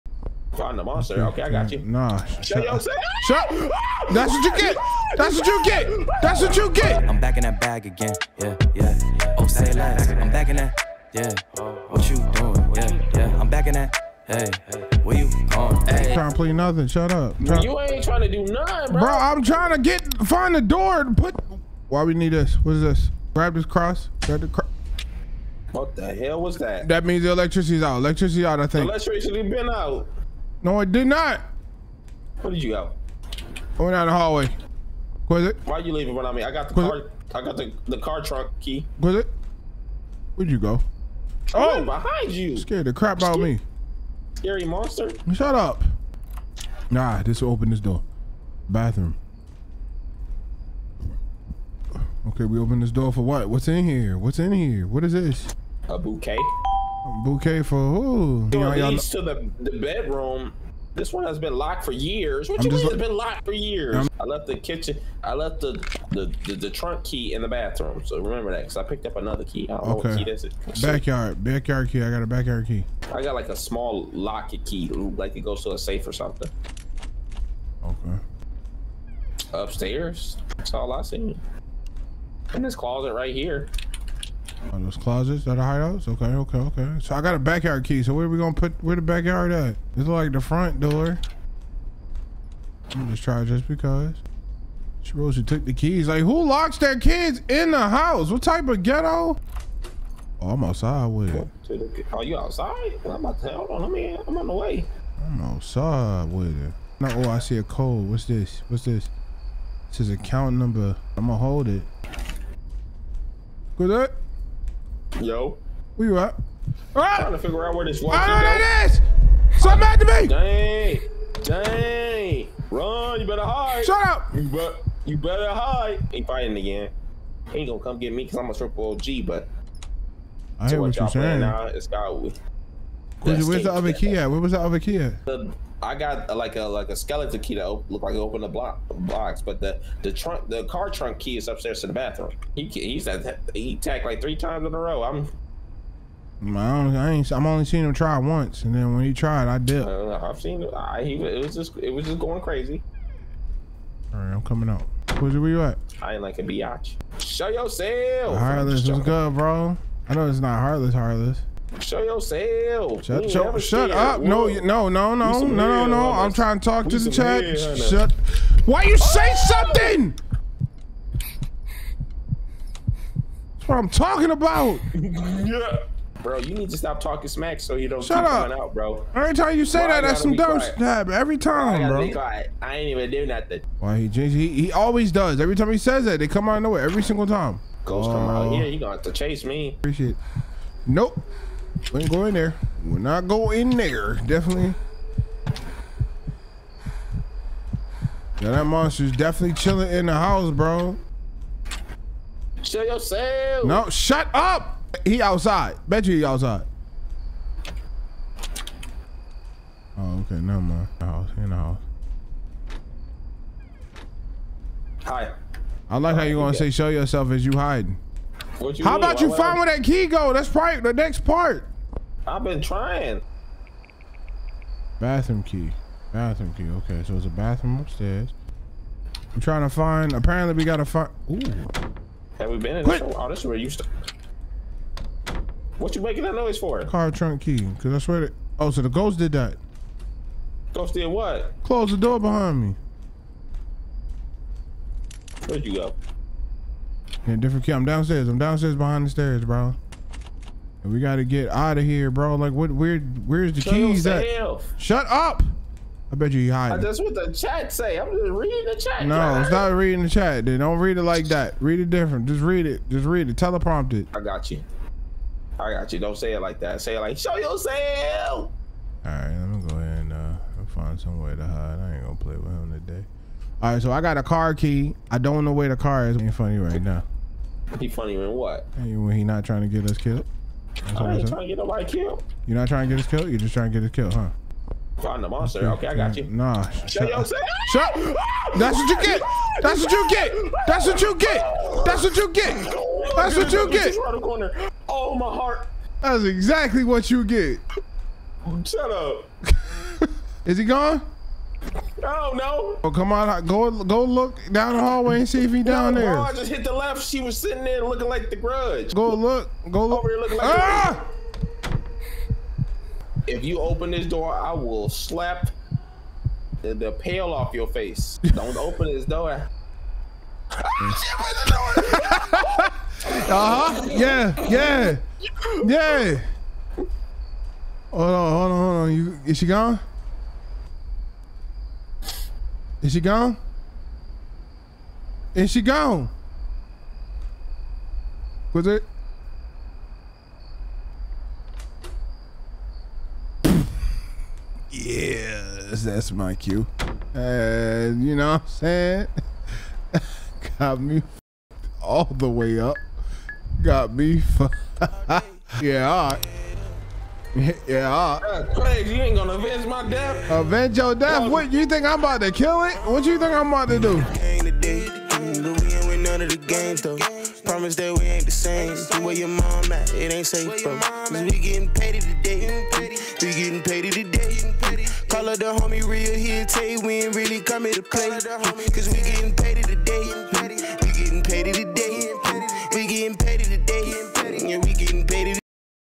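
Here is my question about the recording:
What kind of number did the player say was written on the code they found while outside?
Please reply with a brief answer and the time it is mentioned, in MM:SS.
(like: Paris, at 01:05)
Account number, at 01:50.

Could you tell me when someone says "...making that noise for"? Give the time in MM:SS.
03:56.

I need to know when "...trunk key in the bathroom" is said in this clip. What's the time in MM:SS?
01:06.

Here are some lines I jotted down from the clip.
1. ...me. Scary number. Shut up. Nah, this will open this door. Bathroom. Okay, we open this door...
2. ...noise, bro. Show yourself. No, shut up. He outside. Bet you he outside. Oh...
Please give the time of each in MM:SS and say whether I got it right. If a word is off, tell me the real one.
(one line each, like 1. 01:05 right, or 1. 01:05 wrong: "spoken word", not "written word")
1. 00:43 wrong: "monster", not "number"
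2. 03:20 wrong: "house", not "noise".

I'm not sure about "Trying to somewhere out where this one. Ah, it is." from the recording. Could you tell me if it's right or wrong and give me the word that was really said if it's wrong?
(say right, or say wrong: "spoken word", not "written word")
wrong: "figure", not "somewhere".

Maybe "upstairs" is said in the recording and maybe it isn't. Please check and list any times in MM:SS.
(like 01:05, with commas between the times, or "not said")
01:19, 02:21, 03:47.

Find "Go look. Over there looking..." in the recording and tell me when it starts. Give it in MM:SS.
05:09.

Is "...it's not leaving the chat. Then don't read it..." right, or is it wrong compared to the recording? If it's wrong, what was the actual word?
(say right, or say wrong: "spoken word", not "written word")
wrong: "reading", not "leaving".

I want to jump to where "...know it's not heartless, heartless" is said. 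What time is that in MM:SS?
02:40.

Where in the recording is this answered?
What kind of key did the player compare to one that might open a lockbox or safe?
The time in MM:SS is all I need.
02:16.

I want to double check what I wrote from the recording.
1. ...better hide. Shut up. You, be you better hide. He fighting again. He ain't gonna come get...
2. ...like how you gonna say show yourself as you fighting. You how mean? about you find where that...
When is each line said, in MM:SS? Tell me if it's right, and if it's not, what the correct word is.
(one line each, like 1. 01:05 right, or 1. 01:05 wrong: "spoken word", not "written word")
1. 02:03 right
2. 03:35 wrong: "hiding", not "fighting".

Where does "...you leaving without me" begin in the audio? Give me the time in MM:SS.
00:35.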